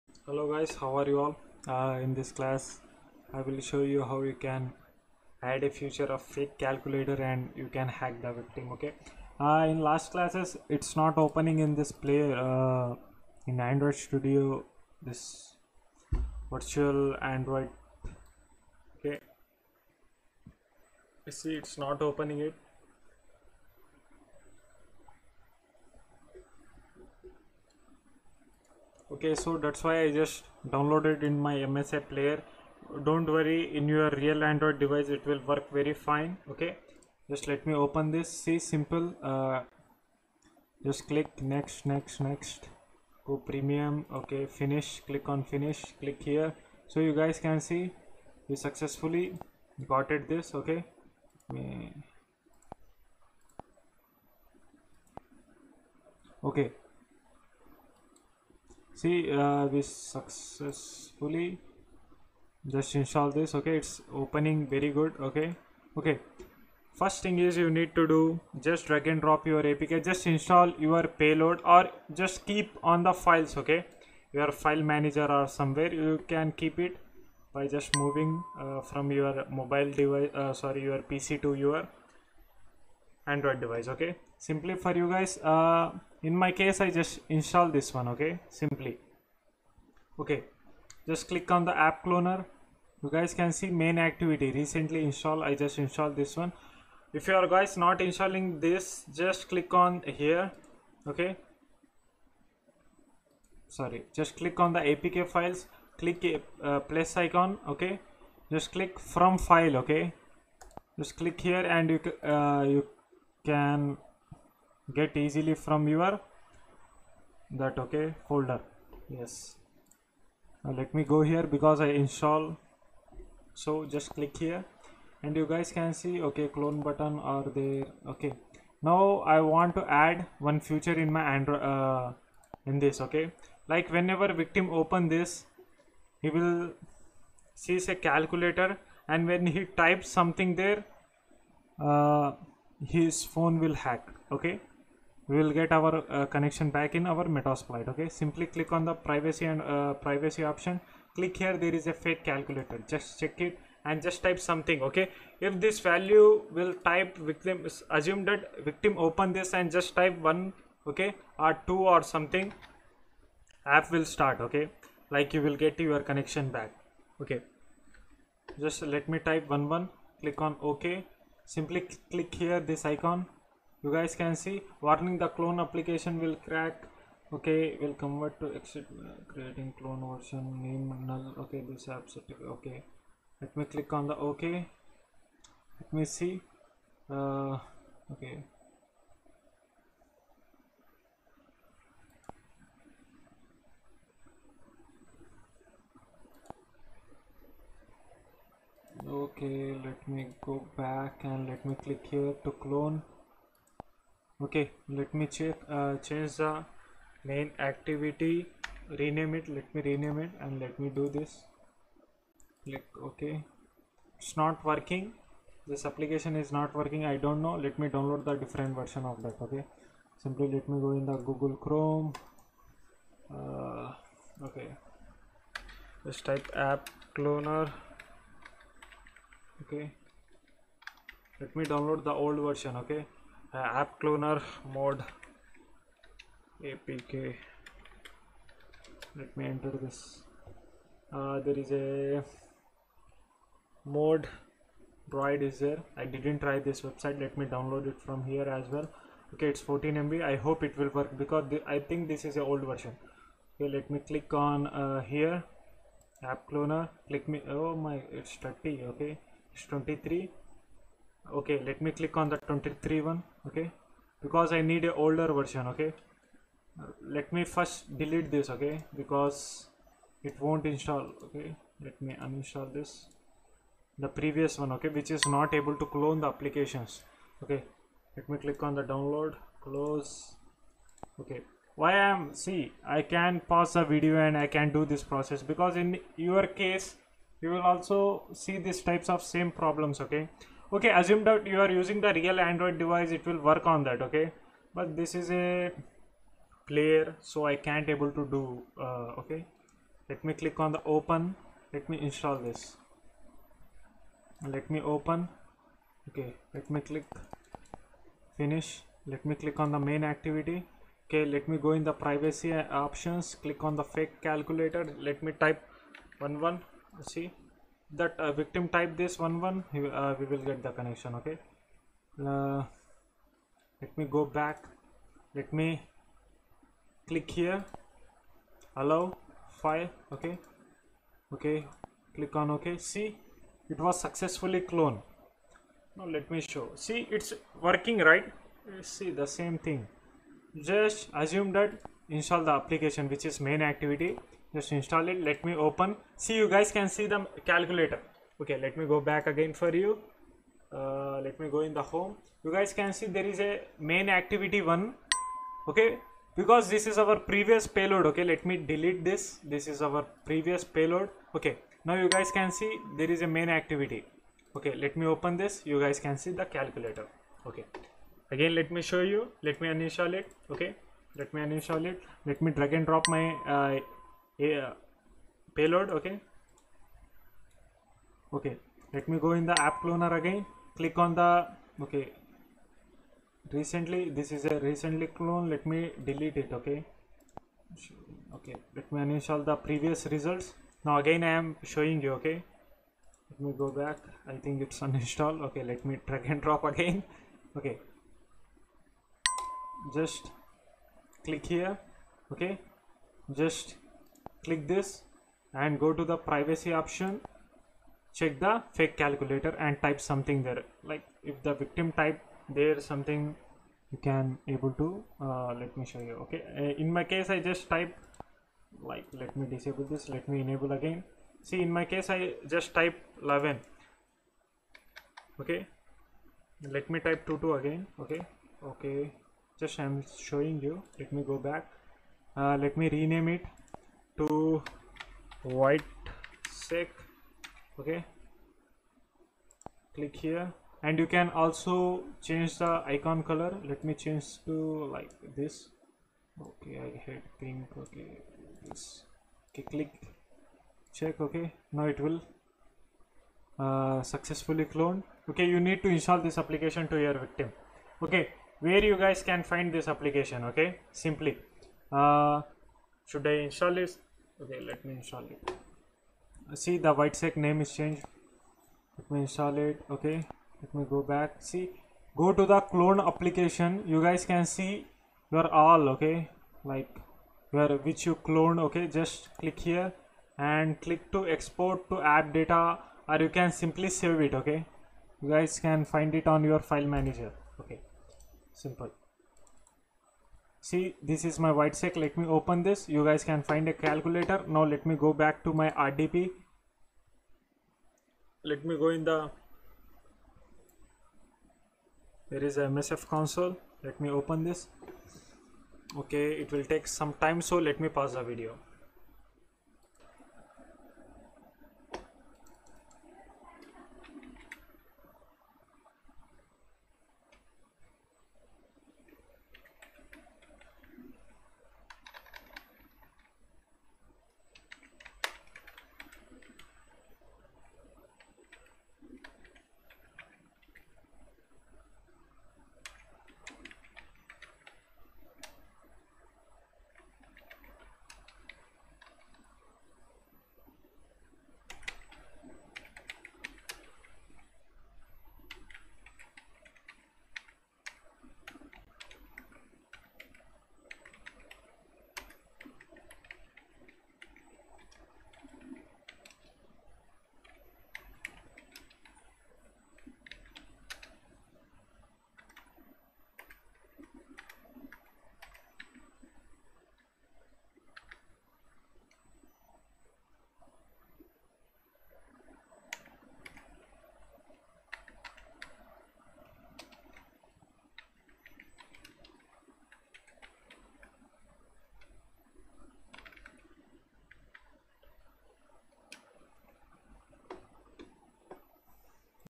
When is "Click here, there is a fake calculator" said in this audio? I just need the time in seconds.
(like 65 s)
151 s.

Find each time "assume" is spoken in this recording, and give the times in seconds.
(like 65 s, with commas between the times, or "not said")
157 s, 290 s, 341 s.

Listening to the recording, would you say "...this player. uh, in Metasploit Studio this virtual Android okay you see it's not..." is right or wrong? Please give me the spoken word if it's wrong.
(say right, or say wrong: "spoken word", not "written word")
wrong: "Android", not "Metasploit".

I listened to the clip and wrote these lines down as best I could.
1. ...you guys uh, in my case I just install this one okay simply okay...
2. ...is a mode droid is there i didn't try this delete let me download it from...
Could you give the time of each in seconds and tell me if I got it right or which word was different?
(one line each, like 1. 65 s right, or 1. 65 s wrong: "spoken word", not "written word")
1. 85 s right
2. 241 s wrong: "website", not "delete".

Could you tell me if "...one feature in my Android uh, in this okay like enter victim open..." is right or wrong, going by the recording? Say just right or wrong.
wrong.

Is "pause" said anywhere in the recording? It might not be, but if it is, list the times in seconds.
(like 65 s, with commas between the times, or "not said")
283 s, 507 s.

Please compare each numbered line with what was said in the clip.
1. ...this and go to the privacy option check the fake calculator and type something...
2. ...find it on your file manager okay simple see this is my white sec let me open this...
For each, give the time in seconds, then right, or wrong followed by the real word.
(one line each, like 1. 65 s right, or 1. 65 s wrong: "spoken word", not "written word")
1. 404 s right
2. 485 s right.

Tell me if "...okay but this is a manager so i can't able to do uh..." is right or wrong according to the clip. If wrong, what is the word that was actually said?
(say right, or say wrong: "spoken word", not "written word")
wrong: "player", not "manager".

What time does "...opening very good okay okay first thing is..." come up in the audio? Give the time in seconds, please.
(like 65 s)
64 s.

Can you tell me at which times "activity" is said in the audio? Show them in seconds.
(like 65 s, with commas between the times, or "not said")
93 s, 207 s, 310 s, 343 s, 354 s, 363 s.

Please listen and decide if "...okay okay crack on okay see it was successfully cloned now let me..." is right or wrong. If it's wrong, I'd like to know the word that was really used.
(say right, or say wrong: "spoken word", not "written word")
wrong: "click", not "crack".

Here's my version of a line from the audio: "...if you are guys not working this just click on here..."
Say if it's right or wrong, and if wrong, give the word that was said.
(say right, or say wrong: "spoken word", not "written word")
wrong: "installing", not "working".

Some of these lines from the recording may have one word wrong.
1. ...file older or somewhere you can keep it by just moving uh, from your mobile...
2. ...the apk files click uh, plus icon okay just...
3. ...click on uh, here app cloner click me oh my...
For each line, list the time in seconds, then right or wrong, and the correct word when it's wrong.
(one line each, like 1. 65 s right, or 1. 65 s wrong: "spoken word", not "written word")
1. 74 s wrong: "manager", not "older"
2. 104 s right
3. 253 s right.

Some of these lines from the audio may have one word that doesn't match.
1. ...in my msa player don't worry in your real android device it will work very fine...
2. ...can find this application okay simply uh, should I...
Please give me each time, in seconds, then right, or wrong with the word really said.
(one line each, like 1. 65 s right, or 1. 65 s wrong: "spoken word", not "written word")
1. 31 s right
2. 459 s right.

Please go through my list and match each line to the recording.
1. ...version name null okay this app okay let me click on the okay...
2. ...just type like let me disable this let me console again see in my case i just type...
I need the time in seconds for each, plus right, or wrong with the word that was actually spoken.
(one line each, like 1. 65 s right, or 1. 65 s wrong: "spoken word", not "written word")
1. 180 s right
2. 417 s wrong: "enable", not "console".